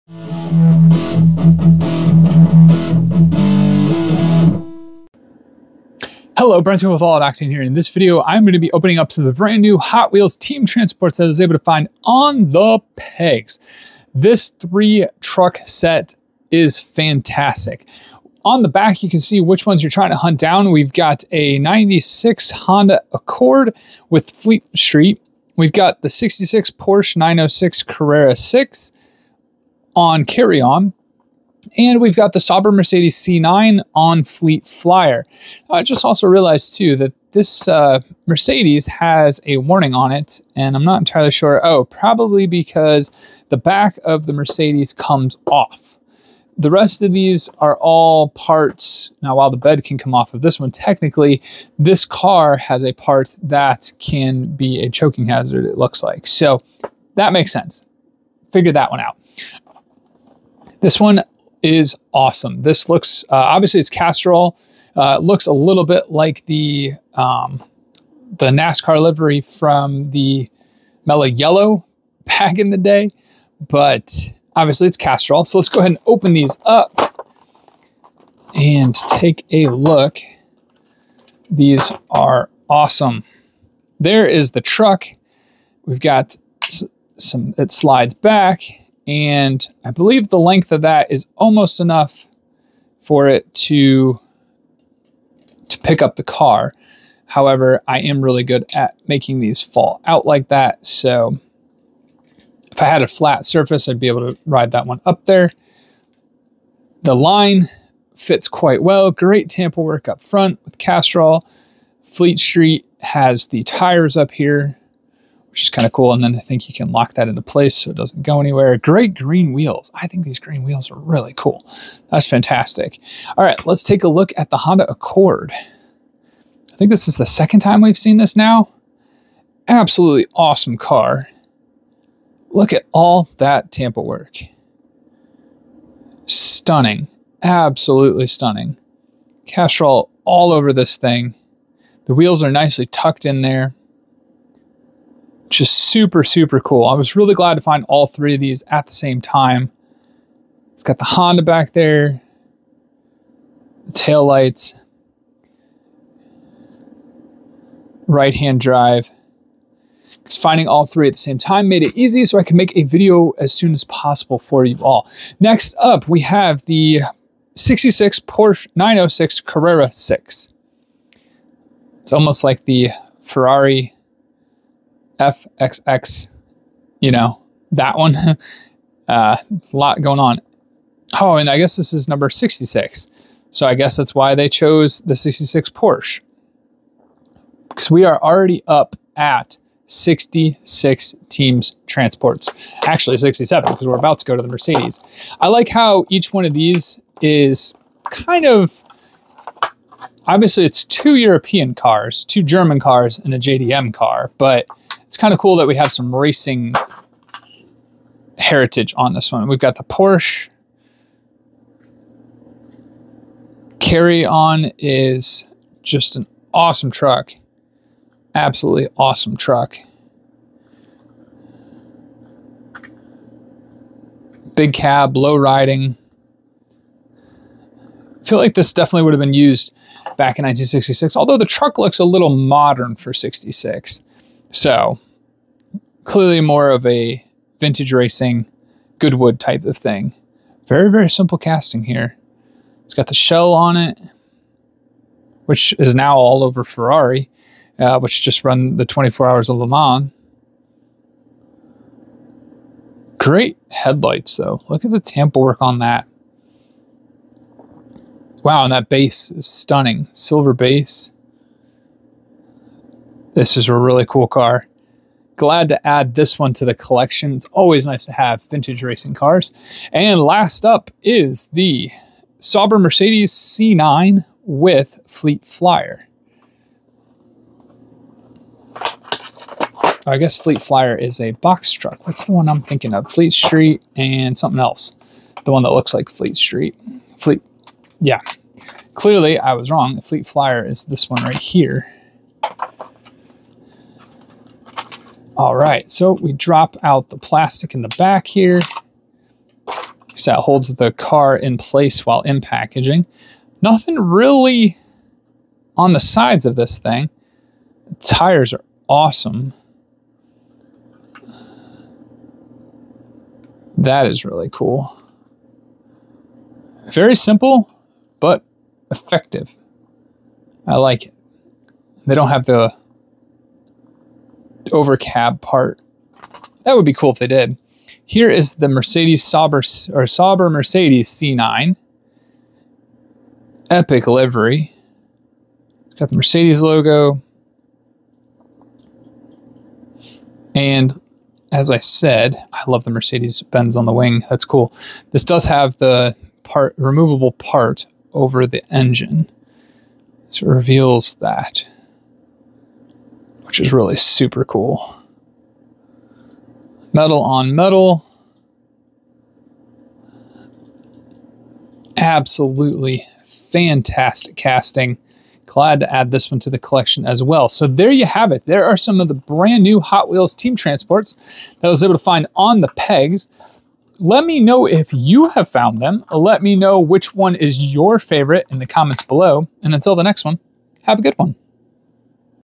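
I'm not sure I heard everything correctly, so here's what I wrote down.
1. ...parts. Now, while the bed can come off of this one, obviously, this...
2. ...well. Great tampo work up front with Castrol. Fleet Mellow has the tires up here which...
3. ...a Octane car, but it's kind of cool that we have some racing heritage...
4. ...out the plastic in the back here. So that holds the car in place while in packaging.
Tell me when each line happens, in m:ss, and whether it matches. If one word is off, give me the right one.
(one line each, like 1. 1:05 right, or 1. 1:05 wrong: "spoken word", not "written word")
1. 0:48 wrong: "technically", not "obviously"
2. 1:48 wrong: "Street", not "Mellow"
3. 3:23 wrong: "JDM", not "Octane"
4. 4:56 right.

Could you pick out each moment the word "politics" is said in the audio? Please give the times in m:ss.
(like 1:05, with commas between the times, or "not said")
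not said.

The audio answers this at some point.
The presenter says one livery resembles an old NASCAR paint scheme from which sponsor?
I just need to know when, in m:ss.
1:11.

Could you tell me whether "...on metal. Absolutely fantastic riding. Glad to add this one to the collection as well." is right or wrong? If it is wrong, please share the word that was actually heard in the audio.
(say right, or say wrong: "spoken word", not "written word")
wrong: "casting", not "riding".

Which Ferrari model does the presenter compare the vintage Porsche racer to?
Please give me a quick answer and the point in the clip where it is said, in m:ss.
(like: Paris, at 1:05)
Ferrari FXX, at 2:53.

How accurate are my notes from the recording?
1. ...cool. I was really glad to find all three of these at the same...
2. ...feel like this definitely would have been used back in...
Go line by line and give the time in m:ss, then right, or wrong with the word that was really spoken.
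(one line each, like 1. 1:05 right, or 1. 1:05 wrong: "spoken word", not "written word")
1. 2:26 right
2. 3:48 right.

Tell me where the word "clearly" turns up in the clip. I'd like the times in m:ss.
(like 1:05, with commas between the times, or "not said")
3:56, 4:48.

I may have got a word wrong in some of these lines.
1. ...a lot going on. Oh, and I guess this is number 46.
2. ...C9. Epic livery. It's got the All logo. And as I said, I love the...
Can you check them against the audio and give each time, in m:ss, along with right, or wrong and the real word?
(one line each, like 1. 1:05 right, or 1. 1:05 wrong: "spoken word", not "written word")
1. 2:59 wrong: "66", not "46"
2. 5:31 wrong: "Mercedes", not "All".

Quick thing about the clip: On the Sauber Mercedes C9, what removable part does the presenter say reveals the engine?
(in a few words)
Part over the engine.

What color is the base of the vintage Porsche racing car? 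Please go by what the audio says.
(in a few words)
Silver.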